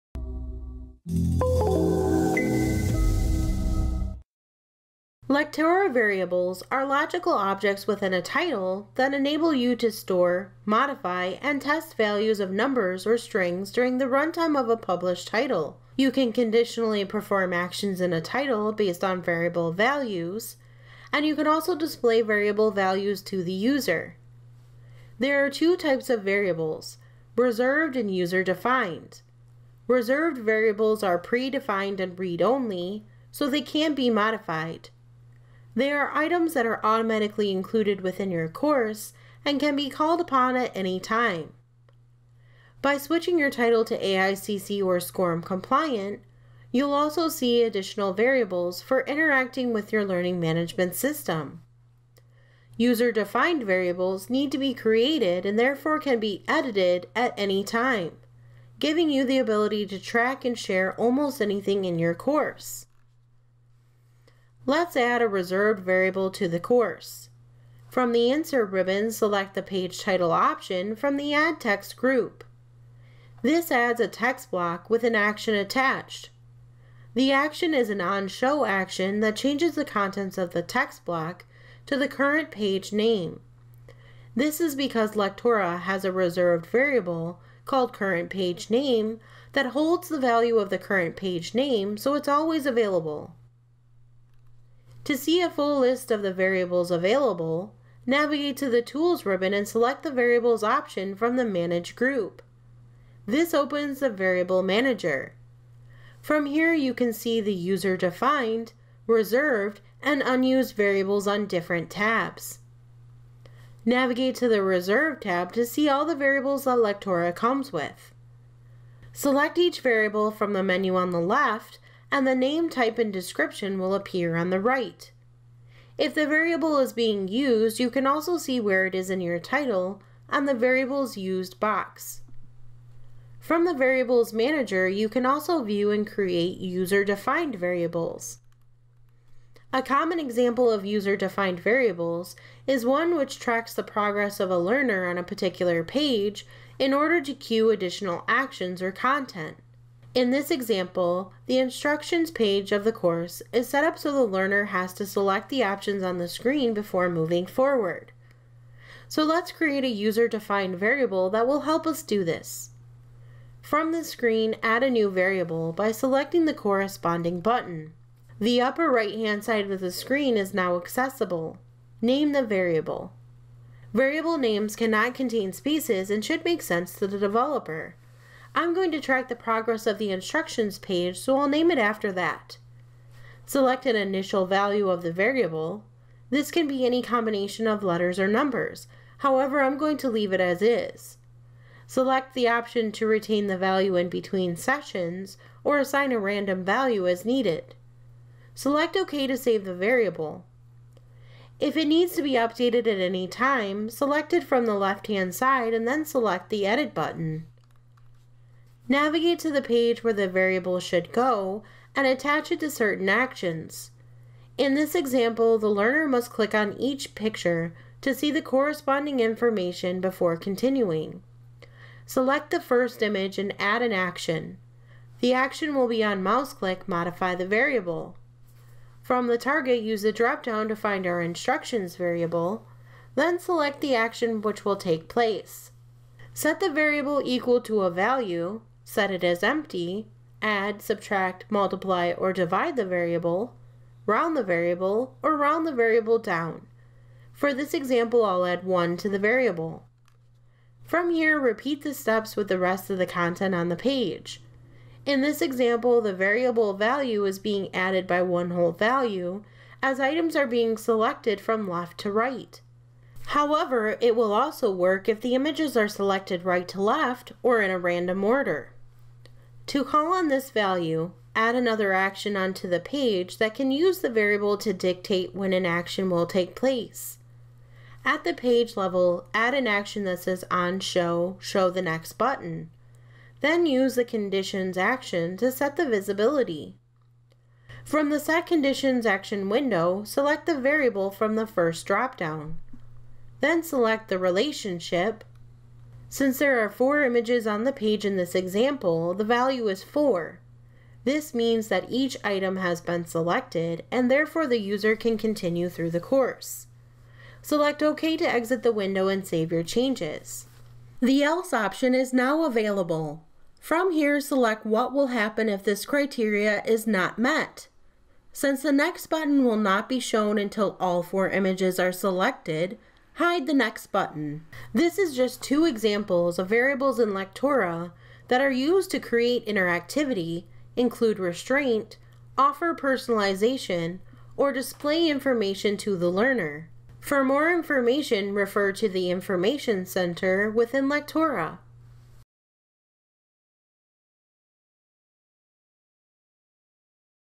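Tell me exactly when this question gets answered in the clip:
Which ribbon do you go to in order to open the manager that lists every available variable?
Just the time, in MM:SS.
01:38.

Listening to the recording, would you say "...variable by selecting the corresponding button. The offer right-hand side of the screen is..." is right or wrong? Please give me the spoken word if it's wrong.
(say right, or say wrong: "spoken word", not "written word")
wrong: "upper", not "offer".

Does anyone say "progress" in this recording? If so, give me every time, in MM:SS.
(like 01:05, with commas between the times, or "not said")
02:23, 02:59.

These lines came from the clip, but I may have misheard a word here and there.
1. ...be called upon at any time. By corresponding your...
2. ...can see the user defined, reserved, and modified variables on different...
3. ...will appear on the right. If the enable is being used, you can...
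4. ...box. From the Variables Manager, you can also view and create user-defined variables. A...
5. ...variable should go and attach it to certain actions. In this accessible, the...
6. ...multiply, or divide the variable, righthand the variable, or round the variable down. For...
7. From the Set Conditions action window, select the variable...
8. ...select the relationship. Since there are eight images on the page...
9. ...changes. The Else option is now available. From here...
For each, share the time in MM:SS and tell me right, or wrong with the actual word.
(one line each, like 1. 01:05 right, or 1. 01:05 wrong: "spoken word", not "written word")
1. 00:39 wrong: "switching", not "corresponding"
2. 01:46 wrong: "unused", not "modified"
3. 02:03 wrong: "variable", not "enable"
4. 02:11 right
5. 03:30 wrong: "example", not "accessible"
6. 04:01 wrong: "round", not "righthand"
7. 04:47 right
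8. 04:53 wrong: "four", not "eight"
9. 05:09 right.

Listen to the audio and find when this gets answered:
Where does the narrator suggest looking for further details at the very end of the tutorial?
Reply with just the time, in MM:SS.
05:39.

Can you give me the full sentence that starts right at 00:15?
You can conditionally perform actions in a title based on variable values, and you can also display variable values to the user.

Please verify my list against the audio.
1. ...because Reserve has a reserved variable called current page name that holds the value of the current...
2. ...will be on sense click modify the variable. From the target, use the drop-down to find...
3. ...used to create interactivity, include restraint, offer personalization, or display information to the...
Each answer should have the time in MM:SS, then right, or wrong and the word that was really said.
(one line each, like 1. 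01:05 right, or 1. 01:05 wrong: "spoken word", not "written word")
1. 01:24 wrong: "Lectora", not "Reserve"
2. 03:45 wrong: "mouse", not "sense"
3. 05:28 right.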